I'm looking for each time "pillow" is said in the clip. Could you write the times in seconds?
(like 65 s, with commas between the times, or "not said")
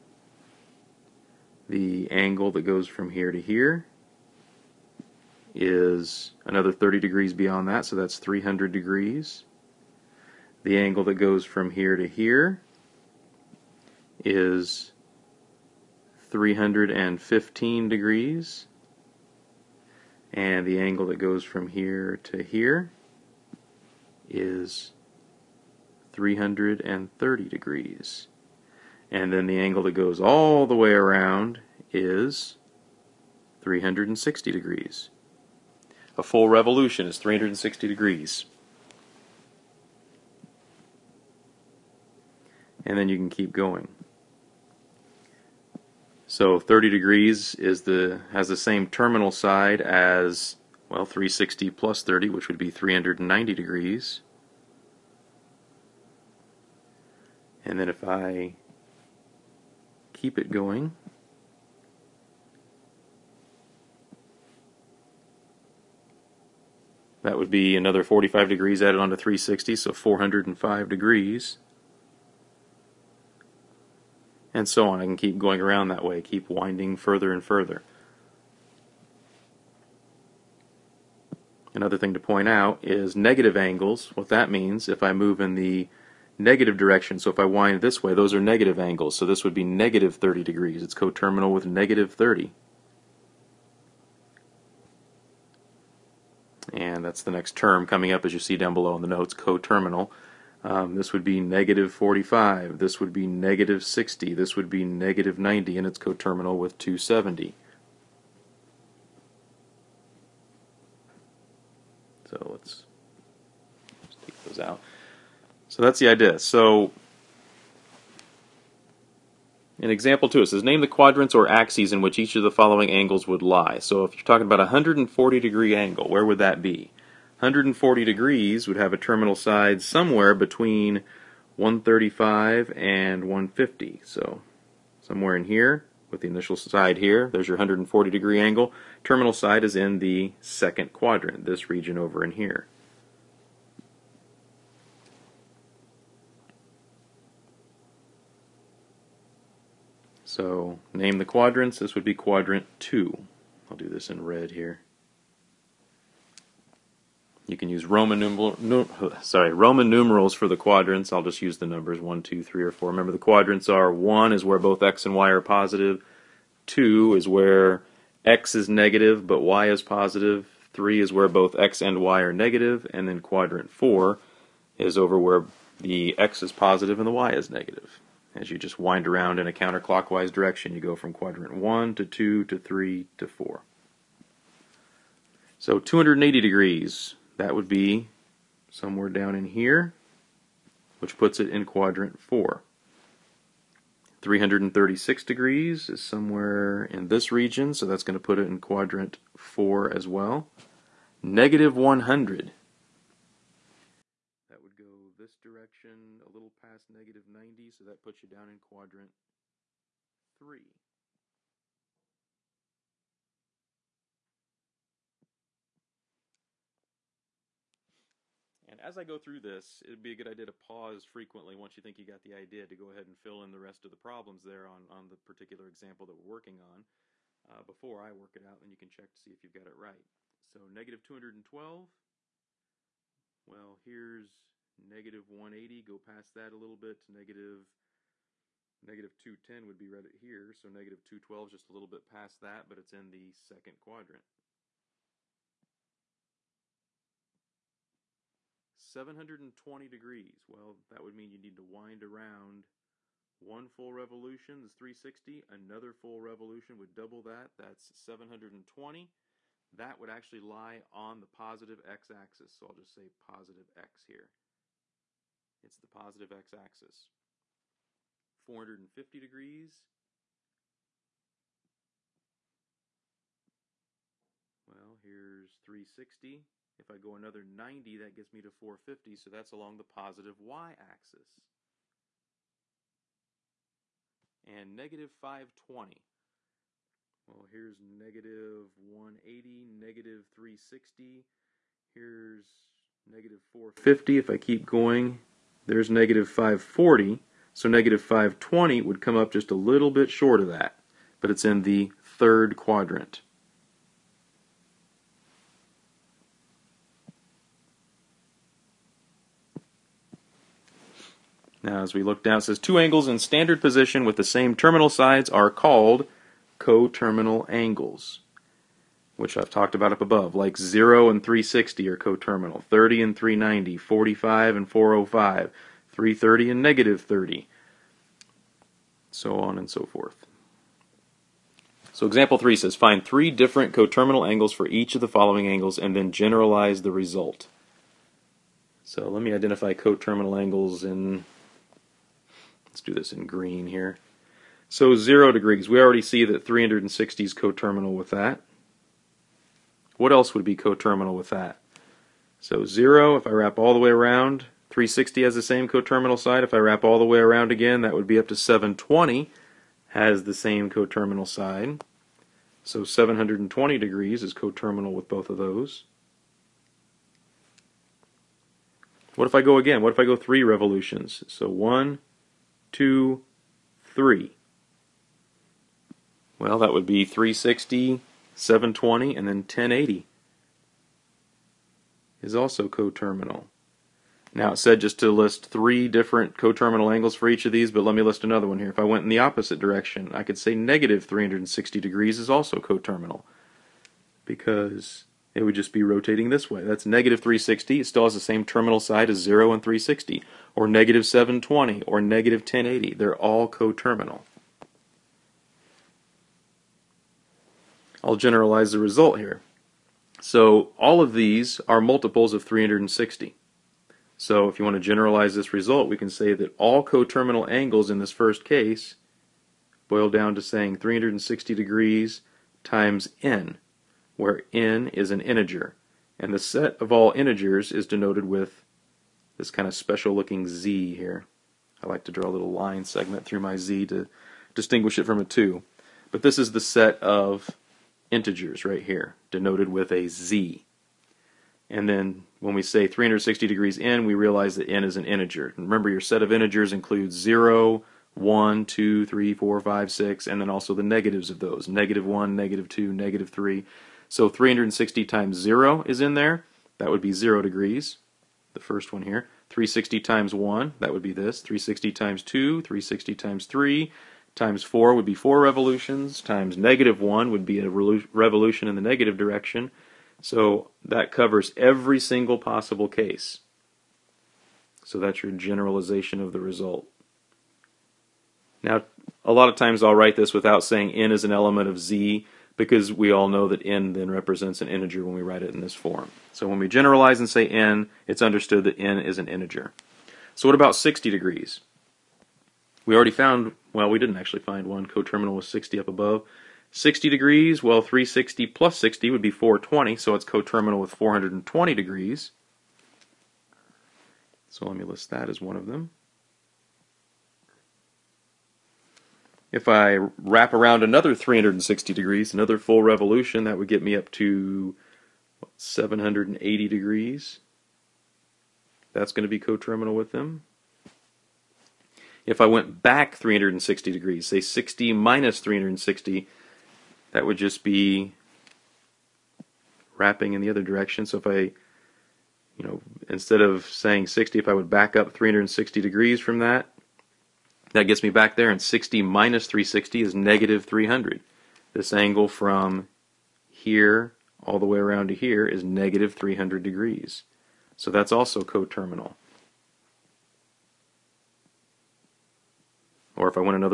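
not said.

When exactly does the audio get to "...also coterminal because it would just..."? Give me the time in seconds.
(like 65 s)
392 s.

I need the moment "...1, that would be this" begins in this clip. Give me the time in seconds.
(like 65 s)
460 s.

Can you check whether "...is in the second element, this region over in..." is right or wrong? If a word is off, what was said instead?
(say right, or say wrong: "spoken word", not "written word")
wrong: "quadrant", not "element".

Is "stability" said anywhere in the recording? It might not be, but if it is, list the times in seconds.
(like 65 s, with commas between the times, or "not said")
not said.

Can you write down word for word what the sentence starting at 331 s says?
So example 3 says, find three different coterminal angles for each of the following angles and then generalize the result.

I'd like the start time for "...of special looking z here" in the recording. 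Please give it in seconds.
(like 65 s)
429 s.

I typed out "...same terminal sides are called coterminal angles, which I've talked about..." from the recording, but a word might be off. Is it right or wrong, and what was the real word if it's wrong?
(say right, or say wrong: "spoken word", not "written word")
right.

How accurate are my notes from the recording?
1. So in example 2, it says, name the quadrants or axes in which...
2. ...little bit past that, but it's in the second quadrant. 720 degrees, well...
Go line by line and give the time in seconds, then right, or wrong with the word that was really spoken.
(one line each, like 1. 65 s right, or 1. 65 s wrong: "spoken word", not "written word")
1. 116 s right
2. 241 s right.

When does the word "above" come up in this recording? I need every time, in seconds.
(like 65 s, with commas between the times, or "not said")
319 s, 495 s.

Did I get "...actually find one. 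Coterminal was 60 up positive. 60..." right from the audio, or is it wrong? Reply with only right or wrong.
wrong.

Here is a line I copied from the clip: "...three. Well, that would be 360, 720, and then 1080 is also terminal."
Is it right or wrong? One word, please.
wrong.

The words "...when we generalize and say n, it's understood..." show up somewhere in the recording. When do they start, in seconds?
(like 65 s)
486 s.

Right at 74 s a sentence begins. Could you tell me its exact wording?
I can keep going around that way, keep winding further and further.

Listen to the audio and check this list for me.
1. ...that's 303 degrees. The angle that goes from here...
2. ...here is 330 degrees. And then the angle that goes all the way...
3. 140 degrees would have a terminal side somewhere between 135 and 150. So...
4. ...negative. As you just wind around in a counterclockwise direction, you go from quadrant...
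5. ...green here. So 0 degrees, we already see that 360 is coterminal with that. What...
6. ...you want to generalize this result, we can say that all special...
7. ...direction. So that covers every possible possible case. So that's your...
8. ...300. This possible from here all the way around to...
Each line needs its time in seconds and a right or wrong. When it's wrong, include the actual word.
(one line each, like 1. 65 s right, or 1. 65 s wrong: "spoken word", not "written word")
1. 7 s wrong: "300", not "303"
2. 22 s right
3. 127 s right
4. 177 s right
5. 343 s right
6. 414 s wrong: "coterminal", not "special"
7. 469 s wrong: "single", not "possible"
8. 540 s wrong: "angle", not "possible".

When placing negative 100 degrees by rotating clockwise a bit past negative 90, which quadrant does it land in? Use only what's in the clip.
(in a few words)
Quadrant 3.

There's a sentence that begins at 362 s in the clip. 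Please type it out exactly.
So 720 degrees is coterminal with both of those.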